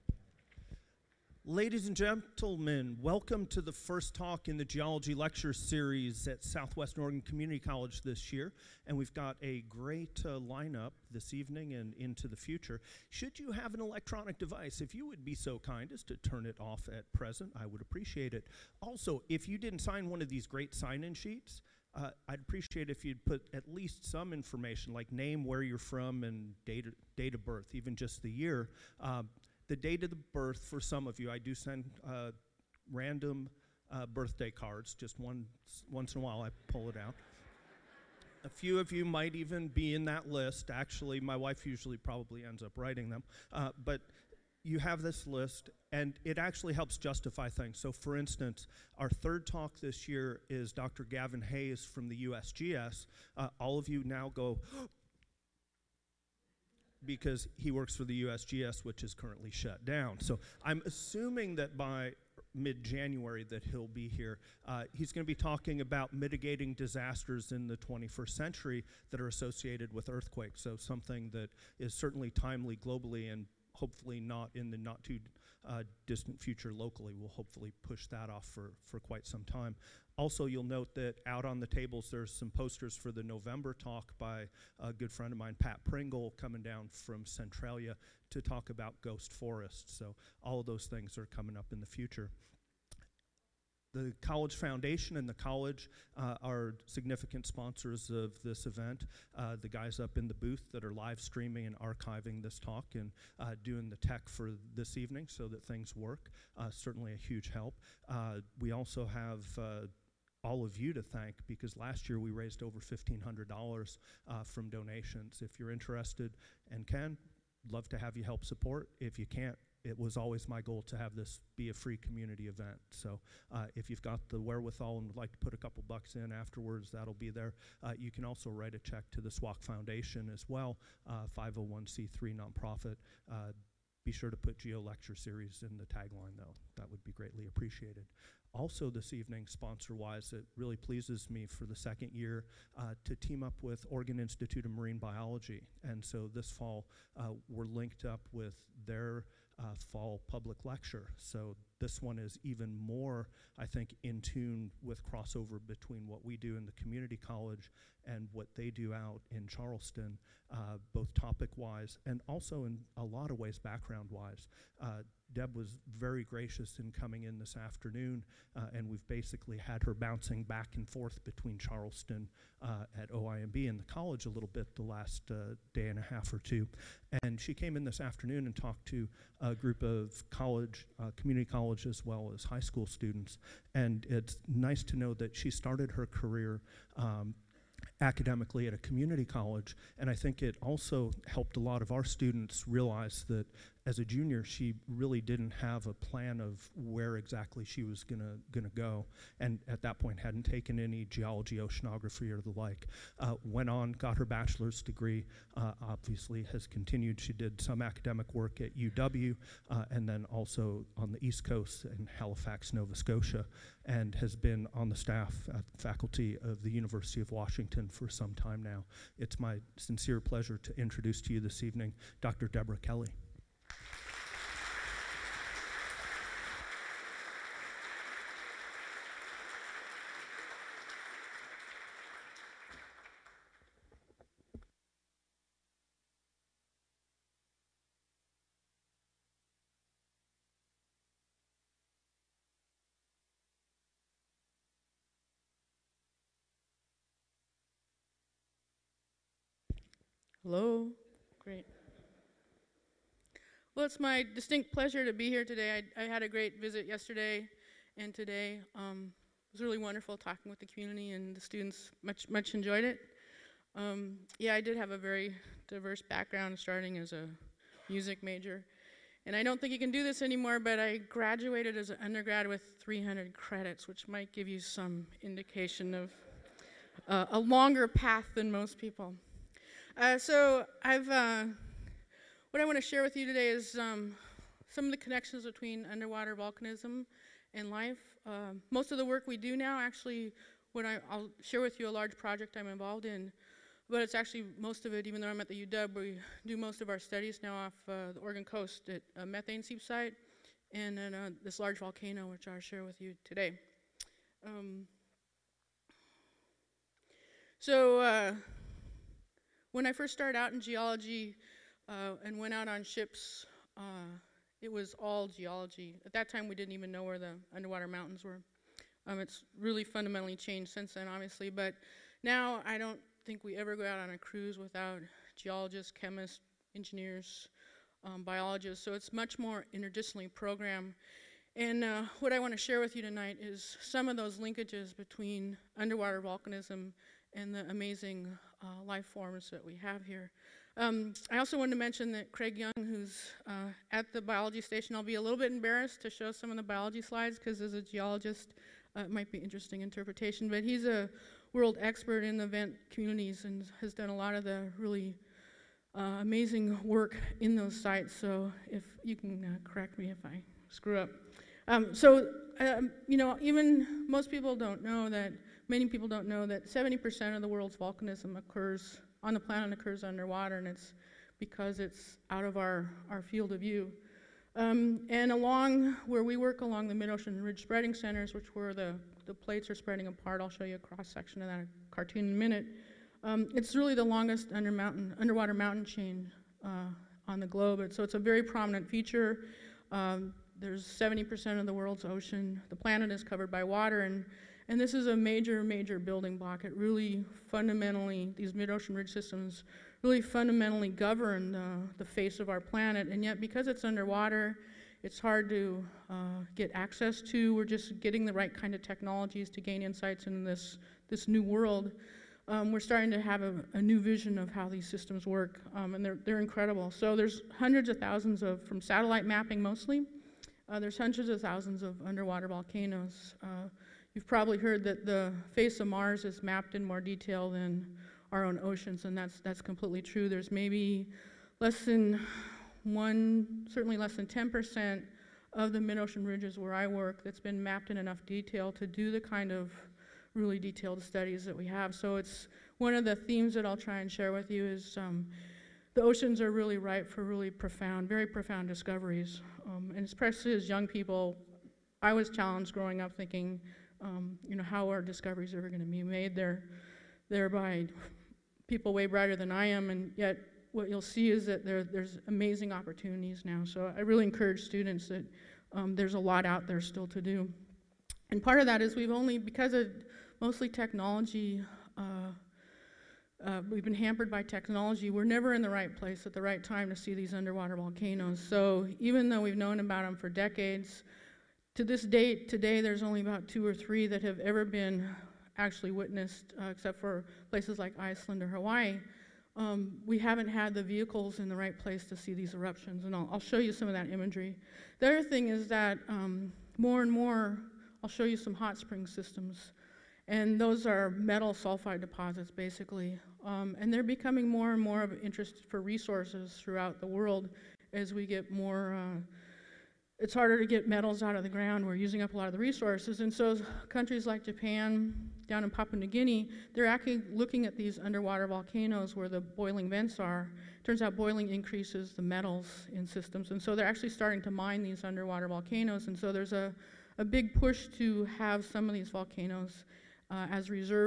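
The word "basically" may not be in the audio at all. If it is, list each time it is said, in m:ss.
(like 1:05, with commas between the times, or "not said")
2:49, 8:22.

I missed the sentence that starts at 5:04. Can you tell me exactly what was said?
Um, so, uh, when I first started out in geology uh, and went out on ships, uh, it was all geology.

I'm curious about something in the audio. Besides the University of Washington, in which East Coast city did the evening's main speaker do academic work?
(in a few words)
Halifax, Nova Scotia.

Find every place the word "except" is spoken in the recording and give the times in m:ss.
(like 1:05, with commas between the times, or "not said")
8:06.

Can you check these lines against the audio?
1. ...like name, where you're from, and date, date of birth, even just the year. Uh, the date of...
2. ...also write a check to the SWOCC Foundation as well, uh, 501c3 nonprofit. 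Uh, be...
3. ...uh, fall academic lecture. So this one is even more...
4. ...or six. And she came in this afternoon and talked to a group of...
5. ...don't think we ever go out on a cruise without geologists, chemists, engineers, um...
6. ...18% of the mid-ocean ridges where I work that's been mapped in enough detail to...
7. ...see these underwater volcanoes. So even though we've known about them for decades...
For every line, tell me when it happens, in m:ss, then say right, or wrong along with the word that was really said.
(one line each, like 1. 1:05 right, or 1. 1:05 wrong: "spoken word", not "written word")
1. 0:24 right
2. 2:08 right
3. 2:29 wrong: "public", not "academic"
4. 2:56 wrong: "two", not "six"
5. 5:22 right
6. 7:14 wrong: "10", not "18"
7. 7:56 right.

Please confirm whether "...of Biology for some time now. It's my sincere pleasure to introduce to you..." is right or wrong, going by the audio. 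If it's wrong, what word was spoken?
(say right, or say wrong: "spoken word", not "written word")
wrong: "Washington", not "Biology".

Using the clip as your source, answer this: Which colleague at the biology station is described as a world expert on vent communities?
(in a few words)
Craig Young.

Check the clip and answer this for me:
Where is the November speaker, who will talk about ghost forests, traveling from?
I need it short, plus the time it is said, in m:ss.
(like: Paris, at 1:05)
Centralia, at 1:27.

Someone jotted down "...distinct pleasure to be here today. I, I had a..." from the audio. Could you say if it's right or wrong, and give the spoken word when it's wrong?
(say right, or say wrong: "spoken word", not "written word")
right.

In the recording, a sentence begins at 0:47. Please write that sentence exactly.
So, for instance, our third talk this year is Dr.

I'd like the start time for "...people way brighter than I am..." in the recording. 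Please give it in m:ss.
7:38.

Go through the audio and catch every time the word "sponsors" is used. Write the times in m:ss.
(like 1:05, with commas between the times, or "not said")
1:37, 2:19.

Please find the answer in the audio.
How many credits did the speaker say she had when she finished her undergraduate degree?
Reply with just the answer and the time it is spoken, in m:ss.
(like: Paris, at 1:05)
300, at 4:32.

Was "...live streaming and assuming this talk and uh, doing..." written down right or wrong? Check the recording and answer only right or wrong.
wrong.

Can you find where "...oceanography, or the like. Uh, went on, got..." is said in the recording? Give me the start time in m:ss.
3:21.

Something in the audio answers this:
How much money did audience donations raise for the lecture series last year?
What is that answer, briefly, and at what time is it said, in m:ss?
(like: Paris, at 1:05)
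$1,500, at 1:52.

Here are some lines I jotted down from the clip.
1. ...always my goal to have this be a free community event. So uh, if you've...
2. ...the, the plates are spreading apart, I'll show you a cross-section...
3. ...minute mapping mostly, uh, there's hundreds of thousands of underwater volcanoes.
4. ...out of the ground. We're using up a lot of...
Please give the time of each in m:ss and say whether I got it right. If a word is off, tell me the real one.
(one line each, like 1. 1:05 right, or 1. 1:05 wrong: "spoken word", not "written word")
1. 2:00 right
2. 6:18 right
3. 6:58 wrong: "satellite", not "minute"
4. 8:31 right.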